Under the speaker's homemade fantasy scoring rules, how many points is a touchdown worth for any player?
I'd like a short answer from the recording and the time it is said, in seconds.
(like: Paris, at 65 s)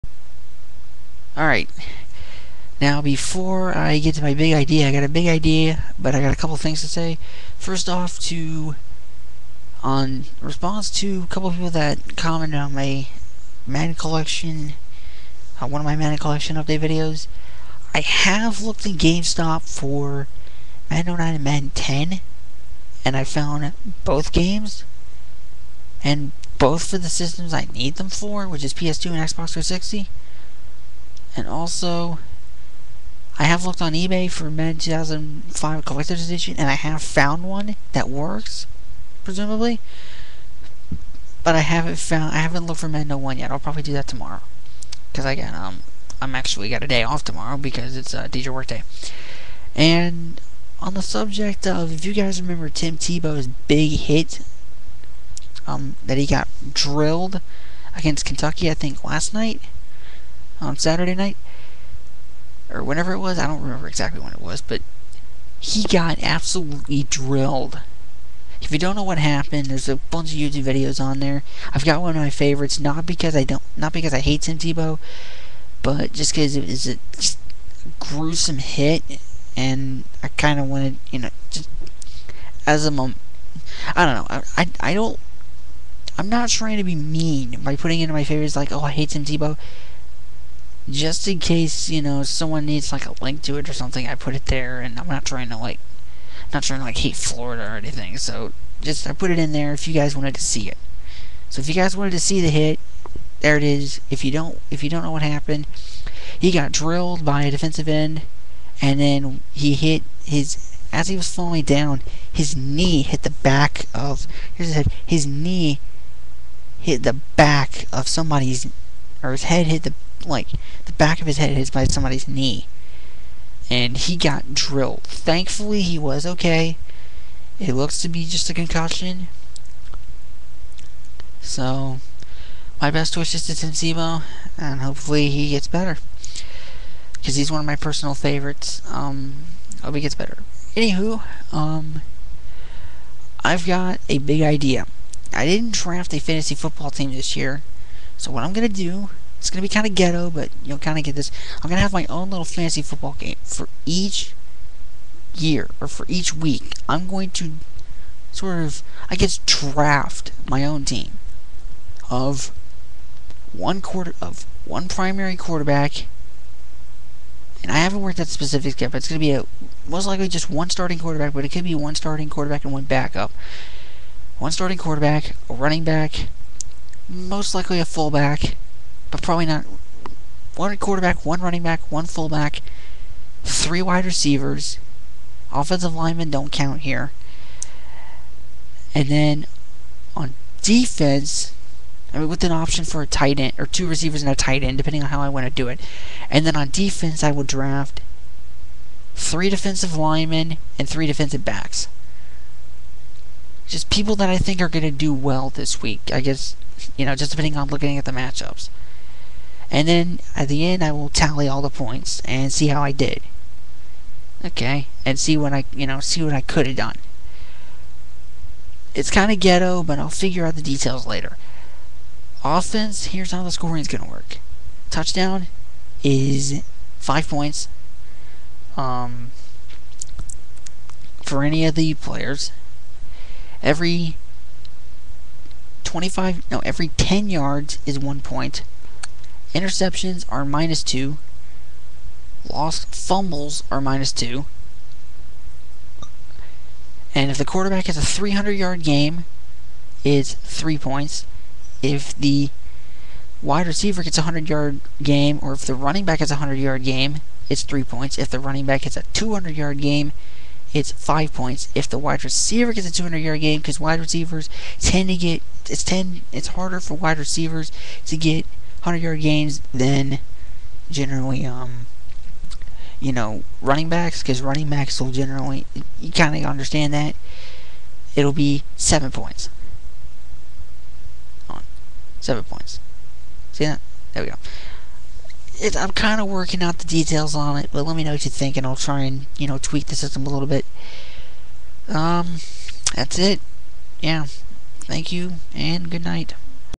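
5, at 226 s.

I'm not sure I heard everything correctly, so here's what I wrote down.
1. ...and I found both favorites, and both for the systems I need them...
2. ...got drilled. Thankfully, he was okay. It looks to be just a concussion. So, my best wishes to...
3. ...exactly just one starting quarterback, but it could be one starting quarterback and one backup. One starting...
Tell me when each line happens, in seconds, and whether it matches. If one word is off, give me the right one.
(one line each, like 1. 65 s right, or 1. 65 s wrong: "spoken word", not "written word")
1. 23 s wrong: "games", not "favorites"
2. 124 s right
3. 170 s wrong: "likely", not "exactly".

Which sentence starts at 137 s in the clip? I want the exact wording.
Because he's one of my personal favorites.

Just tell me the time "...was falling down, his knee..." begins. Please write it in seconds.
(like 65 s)
111 s.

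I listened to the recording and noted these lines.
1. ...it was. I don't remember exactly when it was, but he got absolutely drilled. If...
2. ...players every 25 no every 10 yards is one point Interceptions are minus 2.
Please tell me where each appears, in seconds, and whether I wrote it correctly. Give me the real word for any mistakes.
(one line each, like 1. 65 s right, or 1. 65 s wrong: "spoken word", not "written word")
1. 63 s right
2. 231 s right.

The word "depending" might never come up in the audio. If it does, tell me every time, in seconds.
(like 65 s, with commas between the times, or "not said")
194 s, 207 s.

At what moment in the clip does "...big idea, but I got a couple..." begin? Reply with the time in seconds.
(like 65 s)
5 s.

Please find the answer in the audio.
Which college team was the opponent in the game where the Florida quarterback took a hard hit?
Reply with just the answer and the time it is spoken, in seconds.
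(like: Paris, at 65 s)
Kentucky, at 58 s.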